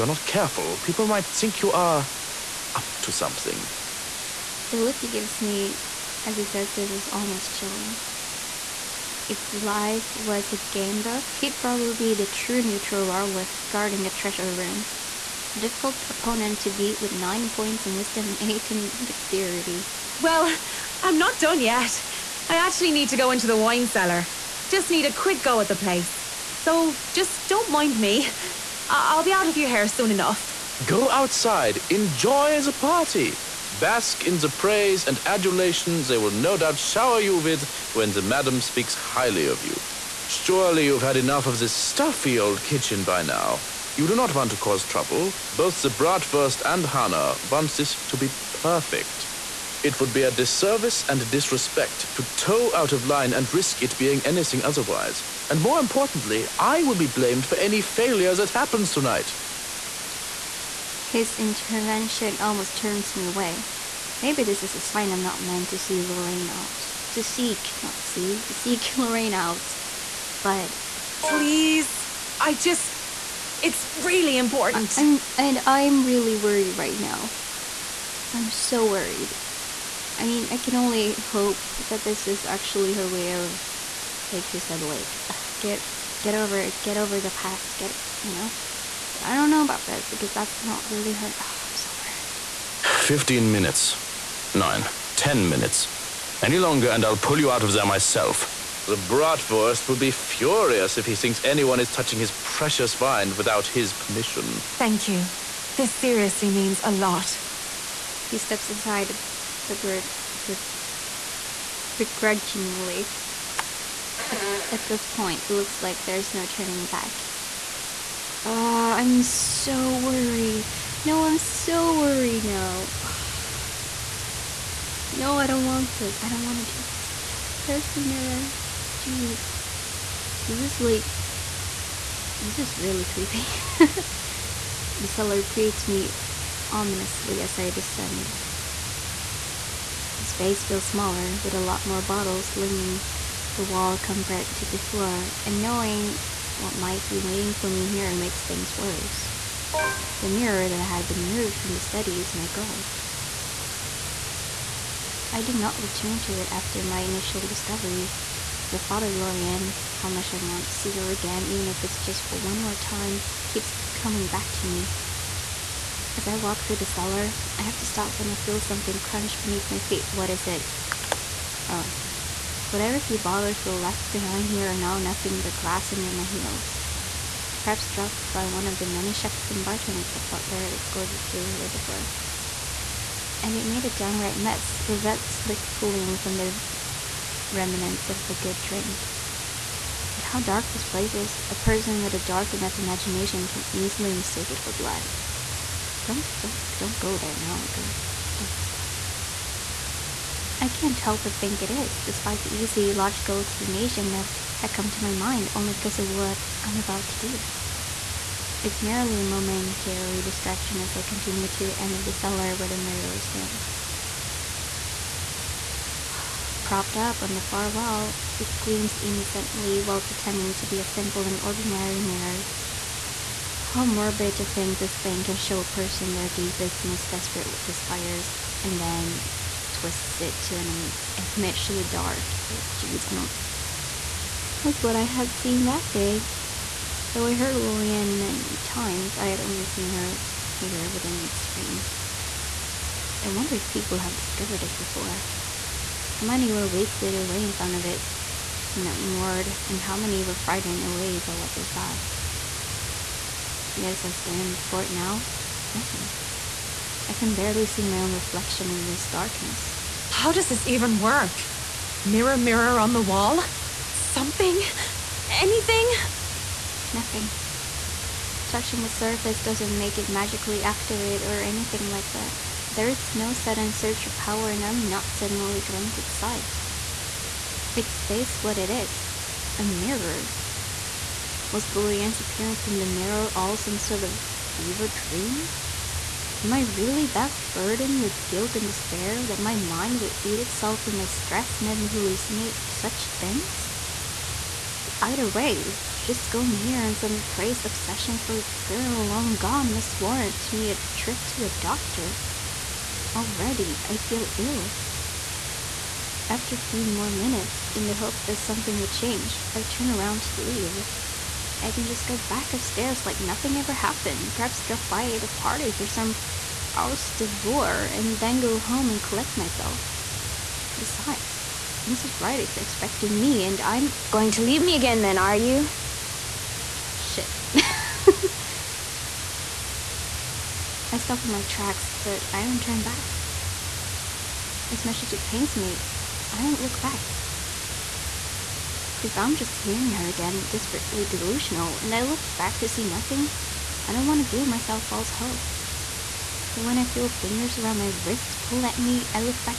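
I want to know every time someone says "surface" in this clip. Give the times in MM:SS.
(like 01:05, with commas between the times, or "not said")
04:28.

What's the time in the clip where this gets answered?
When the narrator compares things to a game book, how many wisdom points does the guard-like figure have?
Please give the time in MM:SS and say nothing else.
00:17.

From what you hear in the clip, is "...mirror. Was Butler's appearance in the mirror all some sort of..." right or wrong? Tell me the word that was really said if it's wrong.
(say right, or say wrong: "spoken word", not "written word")
wrong: "Lorianne", not "Butler".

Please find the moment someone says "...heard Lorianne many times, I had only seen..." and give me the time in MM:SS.
03:57.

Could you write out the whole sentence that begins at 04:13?
Yet as I stand before it now, nothing.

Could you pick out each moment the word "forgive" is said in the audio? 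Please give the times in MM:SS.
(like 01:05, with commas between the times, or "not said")
not said.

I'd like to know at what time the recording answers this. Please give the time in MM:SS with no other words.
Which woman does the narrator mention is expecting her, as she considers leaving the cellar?
05:21.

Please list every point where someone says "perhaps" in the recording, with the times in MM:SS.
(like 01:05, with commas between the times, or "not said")
02:57, 05:14.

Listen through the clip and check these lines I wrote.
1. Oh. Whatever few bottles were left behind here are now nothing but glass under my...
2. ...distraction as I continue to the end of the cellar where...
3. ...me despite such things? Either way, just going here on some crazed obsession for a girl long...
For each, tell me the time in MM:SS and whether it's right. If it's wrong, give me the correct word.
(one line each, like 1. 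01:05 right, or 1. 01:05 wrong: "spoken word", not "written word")
1. 02:51 right
2. 03:30 right
3. 04:51 wrong: "hallucinate", not "despite".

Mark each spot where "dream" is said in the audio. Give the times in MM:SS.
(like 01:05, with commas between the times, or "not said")
04:44.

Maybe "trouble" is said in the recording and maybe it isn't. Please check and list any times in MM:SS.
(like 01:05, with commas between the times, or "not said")
00:44.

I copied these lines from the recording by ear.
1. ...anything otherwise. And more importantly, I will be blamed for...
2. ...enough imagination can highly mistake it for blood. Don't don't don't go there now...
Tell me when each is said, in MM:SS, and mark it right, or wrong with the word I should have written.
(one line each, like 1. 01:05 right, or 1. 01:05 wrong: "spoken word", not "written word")
1. 00:54 right
2. 03:12 wrong: "easily", not "highly".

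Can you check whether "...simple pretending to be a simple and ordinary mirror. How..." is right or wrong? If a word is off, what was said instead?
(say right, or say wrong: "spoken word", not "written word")
wrong: "while", not "simple".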